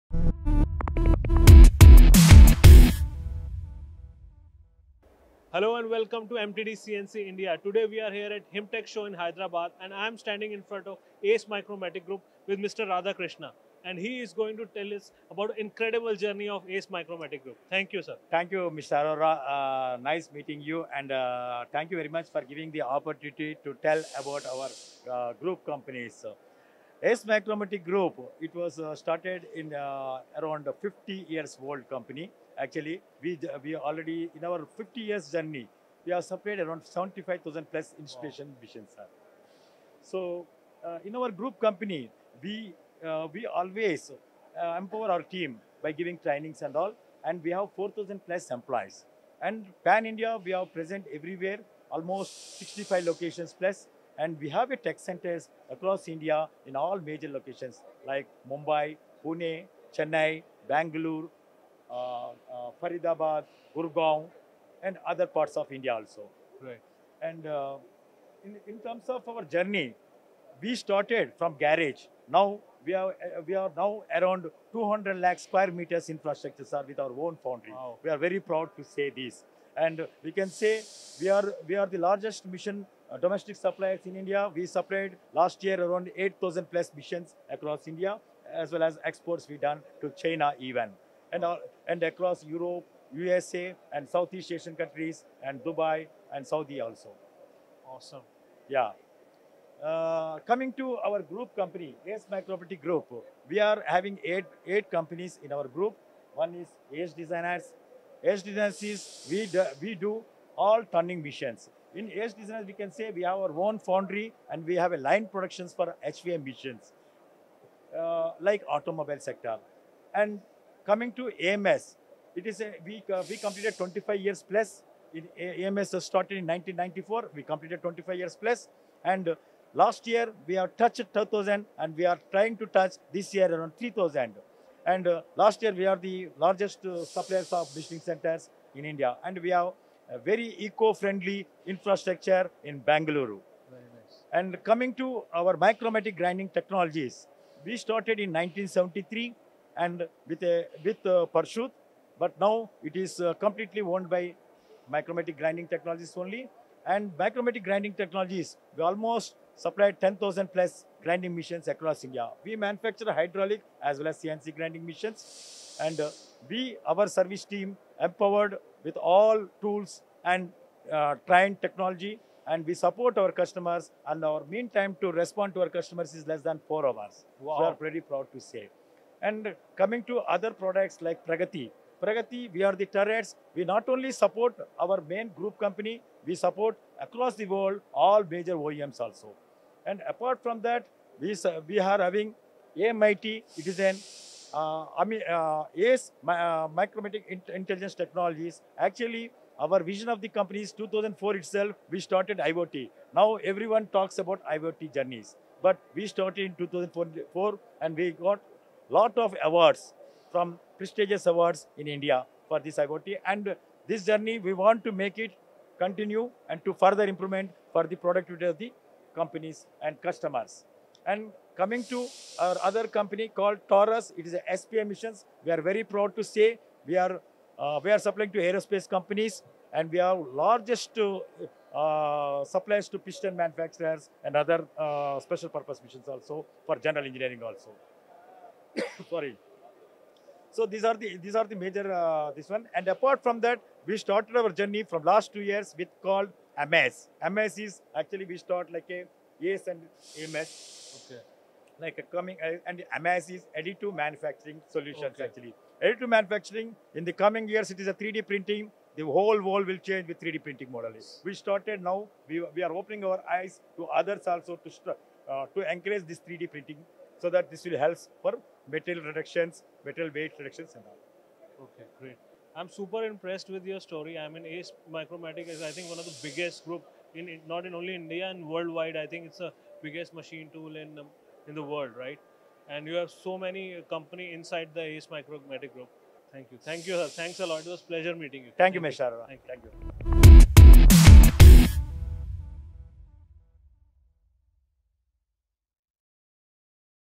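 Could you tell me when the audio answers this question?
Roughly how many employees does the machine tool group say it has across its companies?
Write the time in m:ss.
0:47.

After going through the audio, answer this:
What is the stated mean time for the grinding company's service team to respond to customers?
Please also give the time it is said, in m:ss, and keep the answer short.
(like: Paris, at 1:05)
Less than 4 hours, at 2:56.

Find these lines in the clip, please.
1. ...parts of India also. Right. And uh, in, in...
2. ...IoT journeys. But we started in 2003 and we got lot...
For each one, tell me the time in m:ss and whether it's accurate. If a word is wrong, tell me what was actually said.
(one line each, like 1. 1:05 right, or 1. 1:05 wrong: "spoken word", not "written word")
1. 1:05 right
2. 3:24 wrong: "2004", not "2003".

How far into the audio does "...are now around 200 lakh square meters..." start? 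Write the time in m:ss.
1:13.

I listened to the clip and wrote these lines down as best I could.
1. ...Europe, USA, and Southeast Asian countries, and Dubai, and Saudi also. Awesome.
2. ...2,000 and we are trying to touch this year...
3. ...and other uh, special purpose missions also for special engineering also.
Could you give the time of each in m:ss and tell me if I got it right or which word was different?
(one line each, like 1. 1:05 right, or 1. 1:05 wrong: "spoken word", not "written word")
1. 1:32 right
2. 2:11 right
3. 3:54 wrong: "general", not "special".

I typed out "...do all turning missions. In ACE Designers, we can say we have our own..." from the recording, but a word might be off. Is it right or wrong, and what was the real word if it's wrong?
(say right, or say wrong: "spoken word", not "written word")
right.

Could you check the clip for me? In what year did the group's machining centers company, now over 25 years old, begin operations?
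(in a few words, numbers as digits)
1994.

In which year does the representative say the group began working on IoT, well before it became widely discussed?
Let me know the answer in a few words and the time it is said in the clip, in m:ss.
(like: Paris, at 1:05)
2004, at 3:20.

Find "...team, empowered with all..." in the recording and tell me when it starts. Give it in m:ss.
2:47.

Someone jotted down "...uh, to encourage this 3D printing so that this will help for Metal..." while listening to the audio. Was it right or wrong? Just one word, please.
right.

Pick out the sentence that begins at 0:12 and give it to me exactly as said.
Radha Krishna and he is going to tell us about incredible journey of Ace Micromatic Group.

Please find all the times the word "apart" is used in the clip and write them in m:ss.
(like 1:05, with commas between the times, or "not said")
3:10, 4:02.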